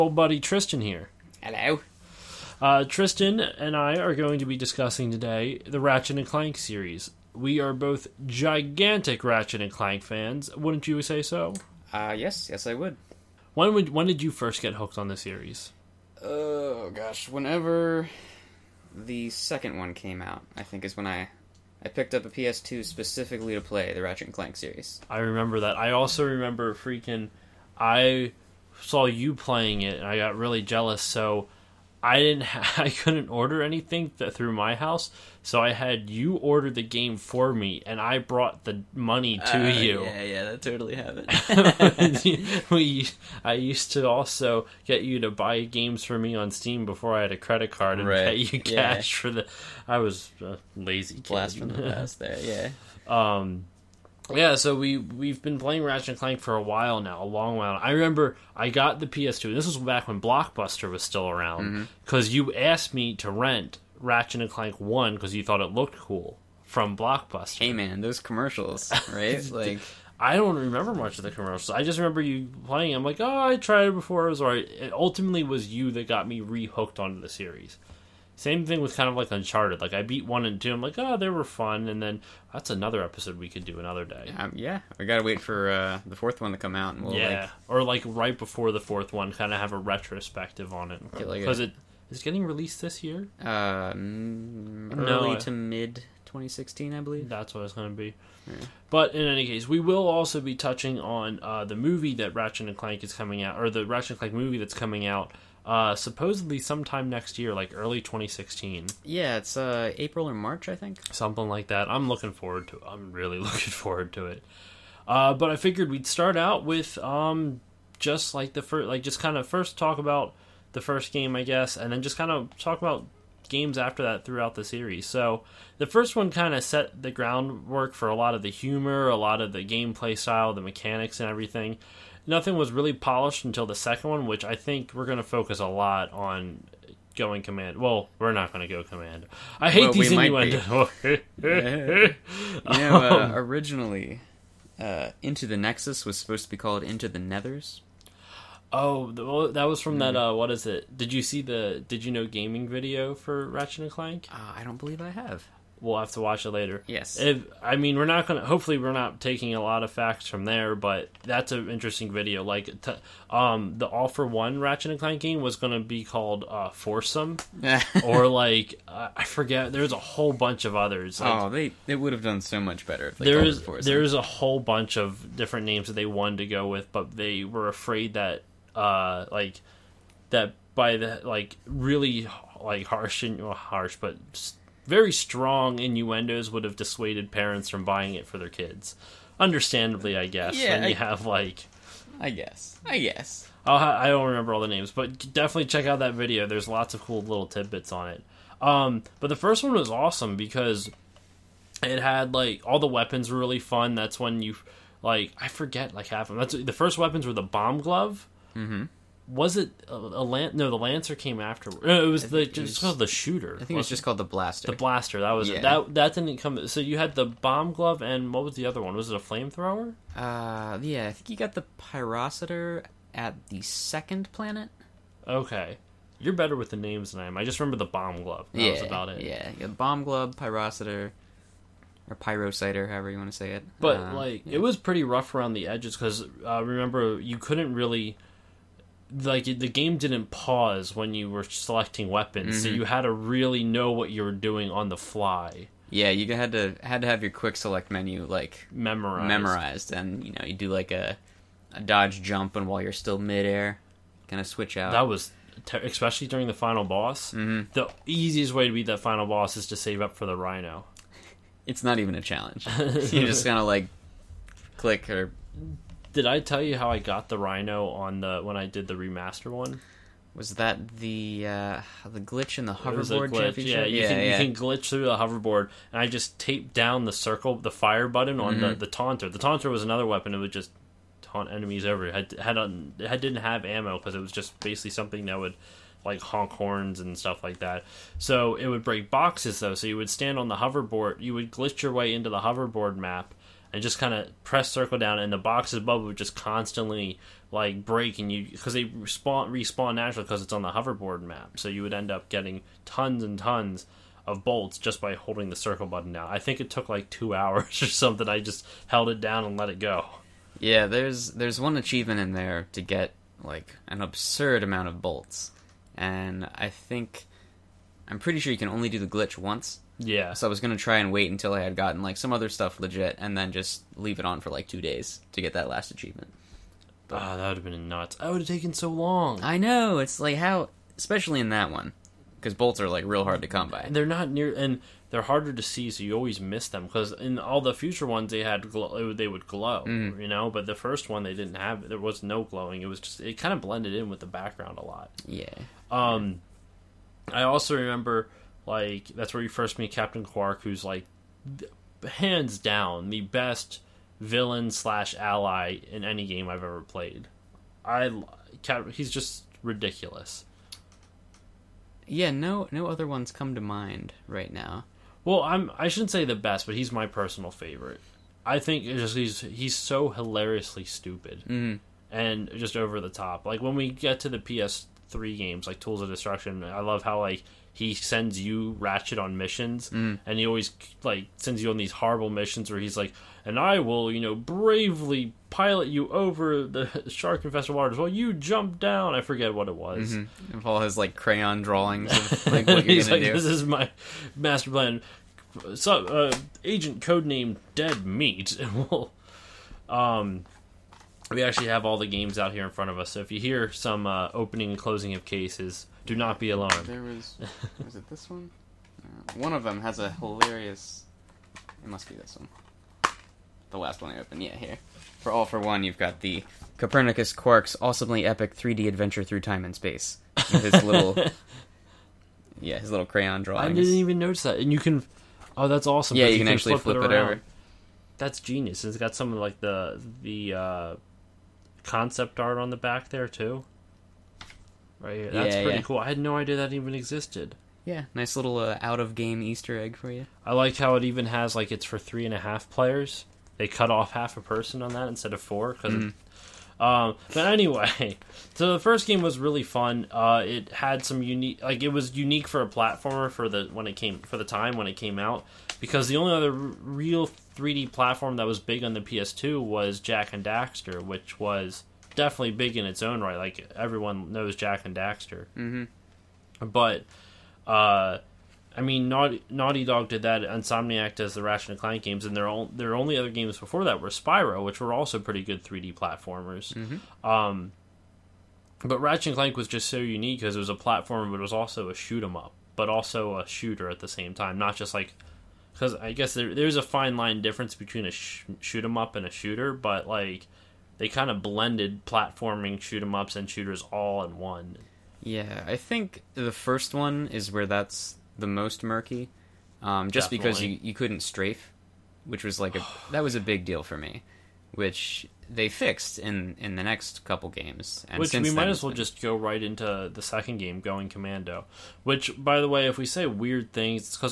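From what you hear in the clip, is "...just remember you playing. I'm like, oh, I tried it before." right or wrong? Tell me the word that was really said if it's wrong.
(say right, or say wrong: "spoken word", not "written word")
right.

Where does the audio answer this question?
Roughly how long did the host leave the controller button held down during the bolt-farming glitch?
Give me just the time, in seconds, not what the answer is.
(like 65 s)
307 s.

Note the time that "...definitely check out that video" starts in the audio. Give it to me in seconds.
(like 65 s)
195 s.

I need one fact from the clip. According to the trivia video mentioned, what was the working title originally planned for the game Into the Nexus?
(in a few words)
Into the Nethers.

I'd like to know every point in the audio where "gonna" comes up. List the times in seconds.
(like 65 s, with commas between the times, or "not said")
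158 s, 165 s, 320 s, 393 s.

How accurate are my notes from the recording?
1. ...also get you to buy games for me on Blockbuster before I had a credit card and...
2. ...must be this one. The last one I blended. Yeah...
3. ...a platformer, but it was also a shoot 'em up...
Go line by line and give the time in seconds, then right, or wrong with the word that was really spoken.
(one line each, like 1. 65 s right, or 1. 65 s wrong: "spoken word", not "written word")
1. 44 s wrong: "Steam", not "Blockbuster"
2. 411 s wrong: "opened", not "blended"
3. 480 s right.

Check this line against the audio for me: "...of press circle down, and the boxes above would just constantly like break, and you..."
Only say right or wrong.
right.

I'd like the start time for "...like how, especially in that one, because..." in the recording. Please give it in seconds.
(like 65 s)
330 s.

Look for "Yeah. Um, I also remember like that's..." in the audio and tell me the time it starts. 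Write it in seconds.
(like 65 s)
345 s.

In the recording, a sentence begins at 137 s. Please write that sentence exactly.
Well, we're not going to go command.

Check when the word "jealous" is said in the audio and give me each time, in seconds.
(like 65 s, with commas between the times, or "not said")
30 s.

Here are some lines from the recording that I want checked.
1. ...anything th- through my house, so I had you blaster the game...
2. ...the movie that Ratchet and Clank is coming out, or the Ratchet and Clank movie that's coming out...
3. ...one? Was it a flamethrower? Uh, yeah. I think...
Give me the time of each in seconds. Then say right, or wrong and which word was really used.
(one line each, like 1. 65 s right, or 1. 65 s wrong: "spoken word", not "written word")
1. 33 s wrong: "order", not "blaster"
2. 101 s right
3. 218 s right.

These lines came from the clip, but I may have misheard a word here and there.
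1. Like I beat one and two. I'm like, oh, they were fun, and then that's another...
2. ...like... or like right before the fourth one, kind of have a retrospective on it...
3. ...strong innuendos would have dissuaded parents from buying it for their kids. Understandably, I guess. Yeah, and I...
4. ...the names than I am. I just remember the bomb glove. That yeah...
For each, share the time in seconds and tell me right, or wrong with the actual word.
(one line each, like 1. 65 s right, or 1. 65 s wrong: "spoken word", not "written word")
1. 79 s right
2. 87 s right
3. 185 s right
4. 226 s right.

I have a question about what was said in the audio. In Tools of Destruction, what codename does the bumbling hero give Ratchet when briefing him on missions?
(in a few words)
Dead Meat.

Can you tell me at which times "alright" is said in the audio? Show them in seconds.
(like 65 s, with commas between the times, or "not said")
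74 s.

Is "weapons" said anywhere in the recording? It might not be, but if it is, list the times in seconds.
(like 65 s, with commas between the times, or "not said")
202 s, 206 s, 242 s, 280 s.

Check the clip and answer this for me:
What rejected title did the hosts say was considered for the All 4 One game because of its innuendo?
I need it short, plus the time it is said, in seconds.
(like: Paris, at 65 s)
Foursome, at 166 s.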